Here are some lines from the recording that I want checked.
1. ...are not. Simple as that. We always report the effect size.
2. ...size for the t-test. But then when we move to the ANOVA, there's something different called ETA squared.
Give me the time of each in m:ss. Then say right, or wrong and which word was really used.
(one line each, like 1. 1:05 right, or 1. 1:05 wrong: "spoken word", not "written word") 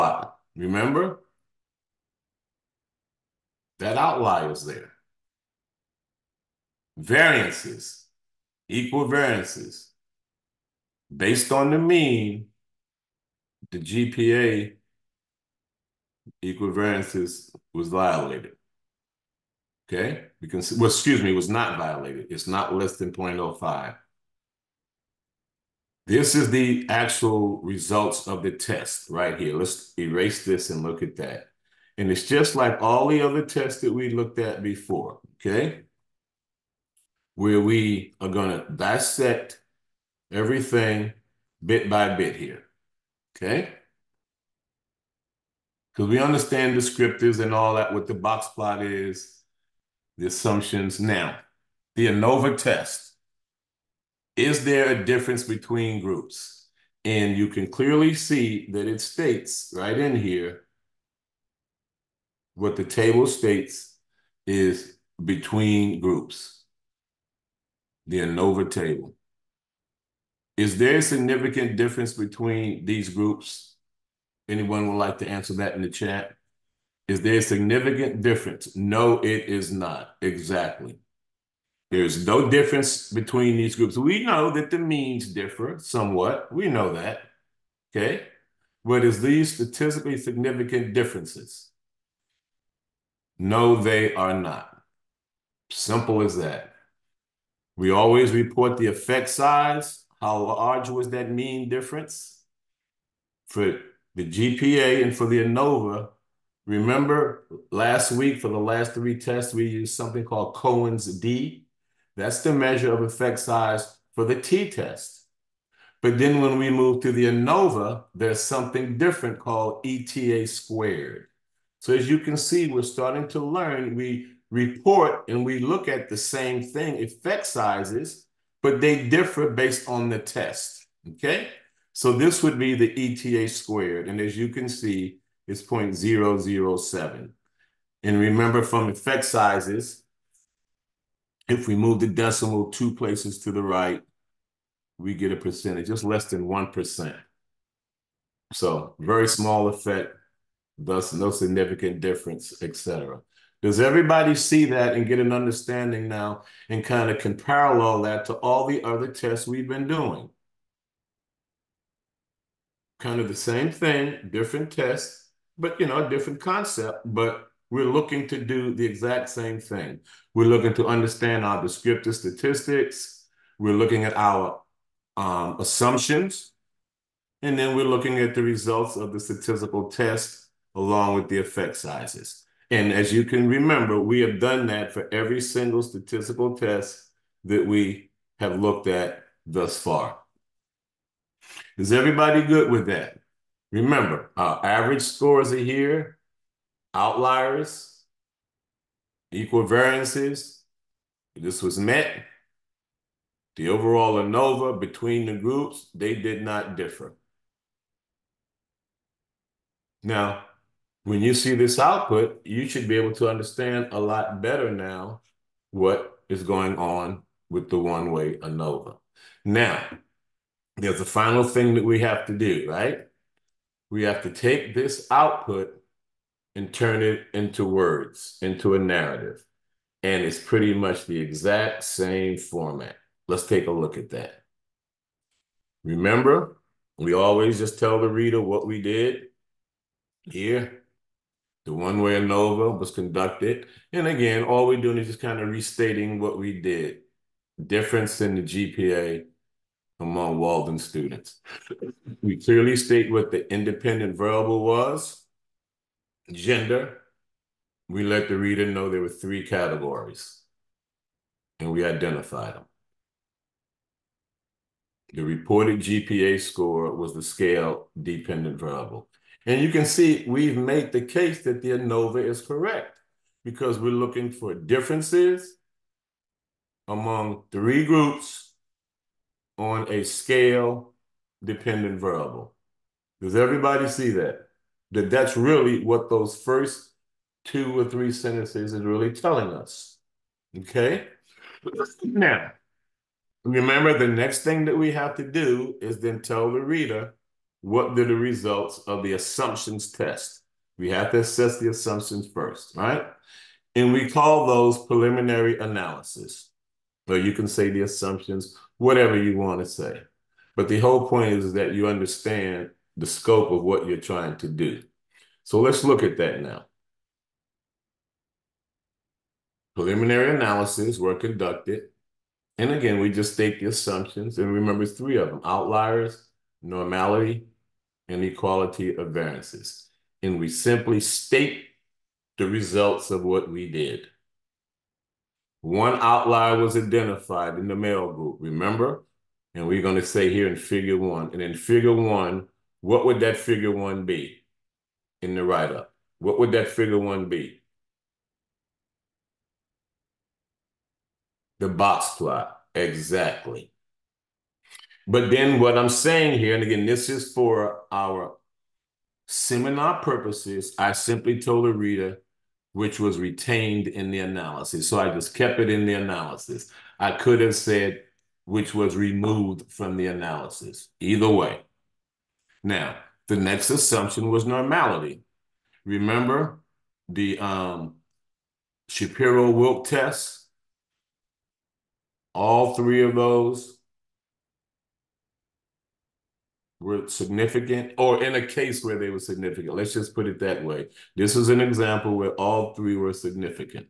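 1. 1:34 right
2. 1:53 right.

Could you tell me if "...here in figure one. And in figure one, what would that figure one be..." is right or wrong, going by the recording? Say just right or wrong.
right.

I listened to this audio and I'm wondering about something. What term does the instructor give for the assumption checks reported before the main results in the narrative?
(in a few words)
preliminary analysis.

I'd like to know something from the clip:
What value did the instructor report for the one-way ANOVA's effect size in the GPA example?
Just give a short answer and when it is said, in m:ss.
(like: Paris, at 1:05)
0.007, at 2:15.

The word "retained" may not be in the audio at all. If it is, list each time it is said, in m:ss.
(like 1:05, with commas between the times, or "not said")
6:03.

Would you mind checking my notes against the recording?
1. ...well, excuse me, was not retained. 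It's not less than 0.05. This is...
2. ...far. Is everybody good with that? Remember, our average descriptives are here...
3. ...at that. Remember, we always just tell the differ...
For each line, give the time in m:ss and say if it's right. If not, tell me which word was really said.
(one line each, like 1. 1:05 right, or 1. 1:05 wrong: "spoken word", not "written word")
1. 0:20 wrong: "violated", not "retained"
2. 3:09 wrong: "scores", not "descriptives"
3. 3:53 wrong: "reader", not "differ".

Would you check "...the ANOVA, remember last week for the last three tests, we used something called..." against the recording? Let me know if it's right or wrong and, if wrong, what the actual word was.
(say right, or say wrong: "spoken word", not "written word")
right.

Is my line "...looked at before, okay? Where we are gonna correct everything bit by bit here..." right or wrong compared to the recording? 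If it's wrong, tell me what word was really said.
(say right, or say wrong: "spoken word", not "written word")
wrong: "dissect", not "correct".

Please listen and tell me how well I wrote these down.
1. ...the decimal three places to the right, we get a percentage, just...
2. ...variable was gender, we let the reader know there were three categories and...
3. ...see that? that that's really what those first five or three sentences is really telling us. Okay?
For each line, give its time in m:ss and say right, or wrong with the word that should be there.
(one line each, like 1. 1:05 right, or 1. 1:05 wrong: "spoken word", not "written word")
1. 2:21 wrong: "two", not "three"
2. 4:14 right
3. 4:43 wrong: "two", not "five".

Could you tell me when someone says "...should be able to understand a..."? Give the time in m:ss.
3:32.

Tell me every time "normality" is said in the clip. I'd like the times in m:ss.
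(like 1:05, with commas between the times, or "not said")
5:26, 6:14.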